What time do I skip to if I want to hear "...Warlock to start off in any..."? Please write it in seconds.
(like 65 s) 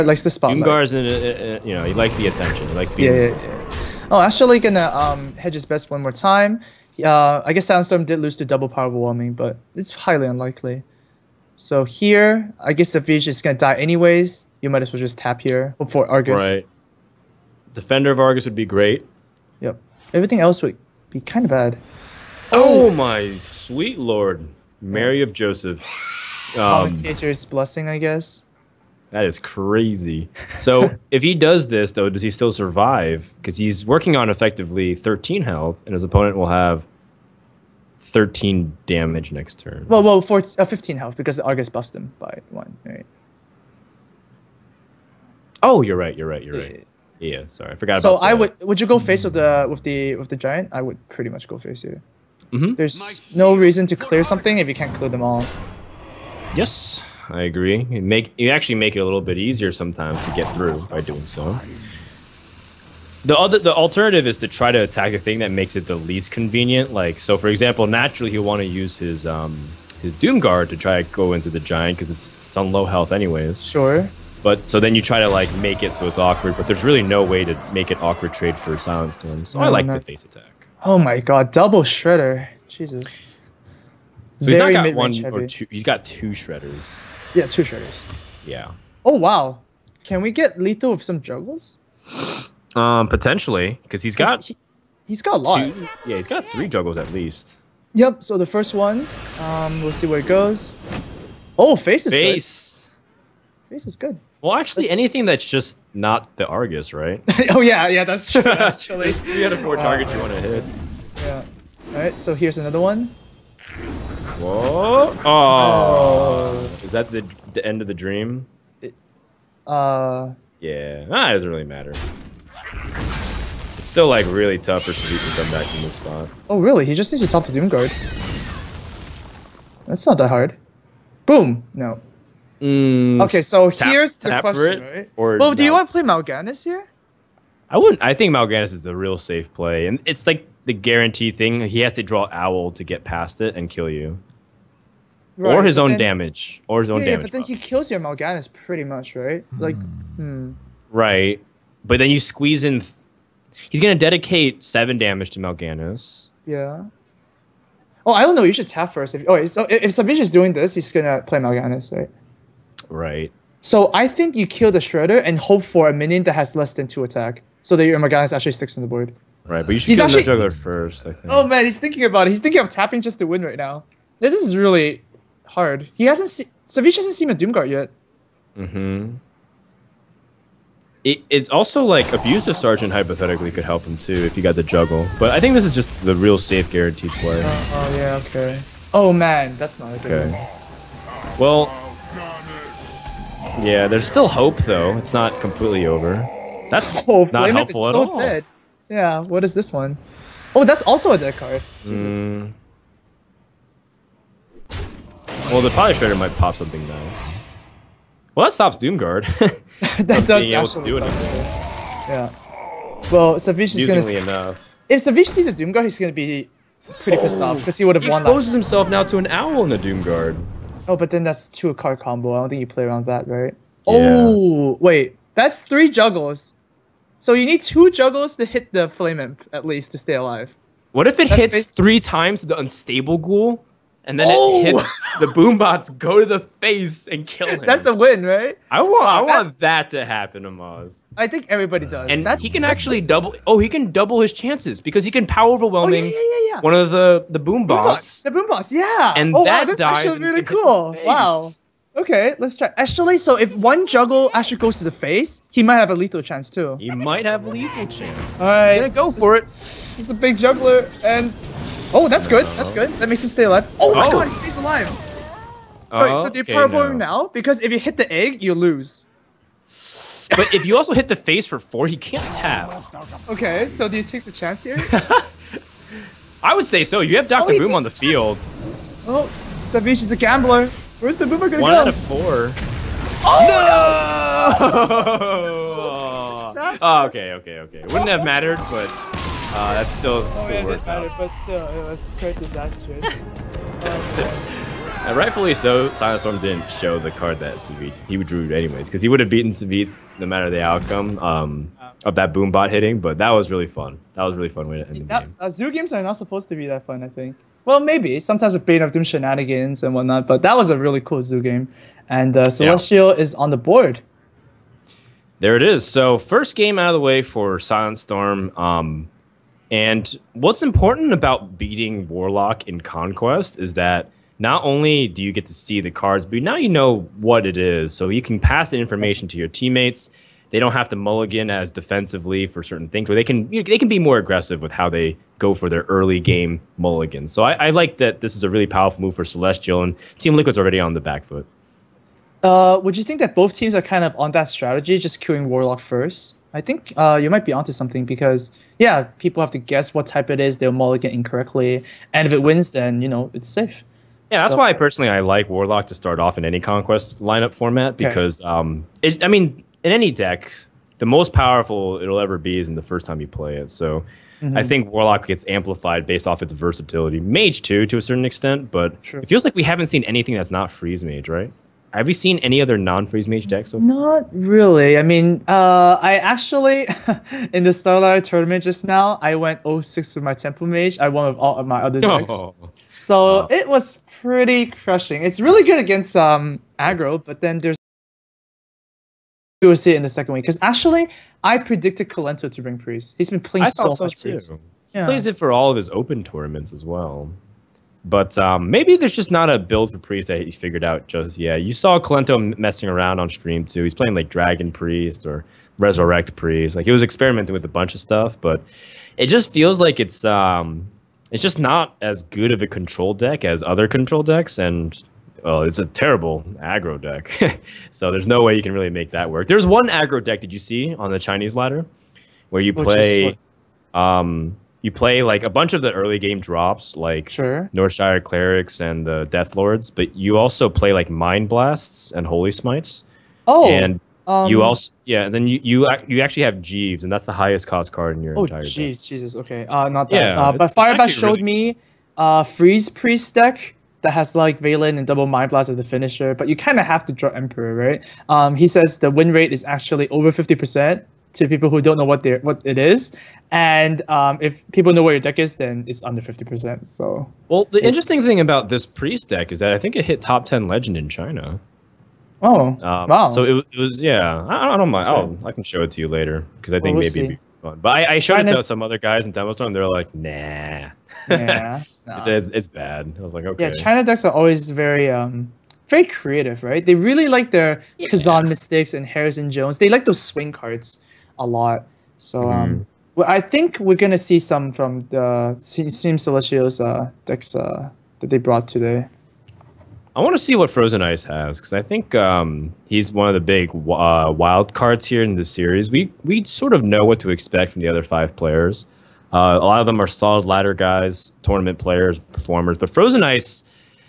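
355 s.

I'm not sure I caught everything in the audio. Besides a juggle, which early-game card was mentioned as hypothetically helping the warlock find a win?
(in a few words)
Abusive Sergeant.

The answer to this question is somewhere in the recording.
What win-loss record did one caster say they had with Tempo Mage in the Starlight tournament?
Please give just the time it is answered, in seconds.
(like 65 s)
379 s.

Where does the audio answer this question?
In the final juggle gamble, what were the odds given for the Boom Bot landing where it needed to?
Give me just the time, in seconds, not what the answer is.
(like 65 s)
281 s.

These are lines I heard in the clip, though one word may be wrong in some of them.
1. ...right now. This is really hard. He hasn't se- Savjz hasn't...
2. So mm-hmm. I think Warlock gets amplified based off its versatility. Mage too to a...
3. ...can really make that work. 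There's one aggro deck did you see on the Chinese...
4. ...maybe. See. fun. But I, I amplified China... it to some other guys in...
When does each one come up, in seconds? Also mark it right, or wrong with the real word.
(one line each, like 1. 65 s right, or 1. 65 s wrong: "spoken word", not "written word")
1. 173 s right
2. 363 s right
3. 418 s right
4. 467 s wrong: "showed", not "amplified".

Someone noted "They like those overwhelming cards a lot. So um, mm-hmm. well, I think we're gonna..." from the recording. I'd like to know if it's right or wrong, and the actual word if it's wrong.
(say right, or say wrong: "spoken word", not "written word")
wrong: "swing", not "overwhelming".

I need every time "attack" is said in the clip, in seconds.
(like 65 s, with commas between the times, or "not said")
64 s, 80 s, 167 s.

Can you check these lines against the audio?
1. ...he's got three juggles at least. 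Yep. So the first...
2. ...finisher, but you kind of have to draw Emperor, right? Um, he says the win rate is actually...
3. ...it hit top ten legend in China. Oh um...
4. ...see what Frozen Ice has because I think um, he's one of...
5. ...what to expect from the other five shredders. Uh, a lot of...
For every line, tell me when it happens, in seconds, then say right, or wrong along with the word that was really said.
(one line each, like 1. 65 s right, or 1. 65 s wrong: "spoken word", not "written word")
1. 96 s right
2. 445 s right
3. 459 s right
4. 490 s right
5. 497 s wrong: "players", not "shredders".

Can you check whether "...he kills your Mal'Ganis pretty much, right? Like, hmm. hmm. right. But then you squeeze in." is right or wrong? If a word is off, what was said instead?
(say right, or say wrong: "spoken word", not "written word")
right.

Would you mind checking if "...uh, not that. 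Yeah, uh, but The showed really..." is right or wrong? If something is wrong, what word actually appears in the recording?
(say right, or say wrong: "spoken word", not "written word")
wrong: "Firebat", not "The".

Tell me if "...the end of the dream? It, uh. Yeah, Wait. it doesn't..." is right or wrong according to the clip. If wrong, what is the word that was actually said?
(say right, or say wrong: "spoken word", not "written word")
wrong: "Nah", not "Wait".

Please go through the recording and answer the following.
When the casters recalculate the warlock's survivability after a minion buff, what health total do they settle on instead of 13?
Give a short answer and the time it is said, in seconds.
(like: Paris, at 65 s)
15, at 40 s.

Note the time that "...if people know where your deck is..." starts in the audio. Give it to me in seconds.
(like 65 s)
454 s.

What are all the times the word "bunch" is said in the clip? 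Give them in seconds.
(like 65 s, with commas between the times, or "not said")
407 s, 425 s.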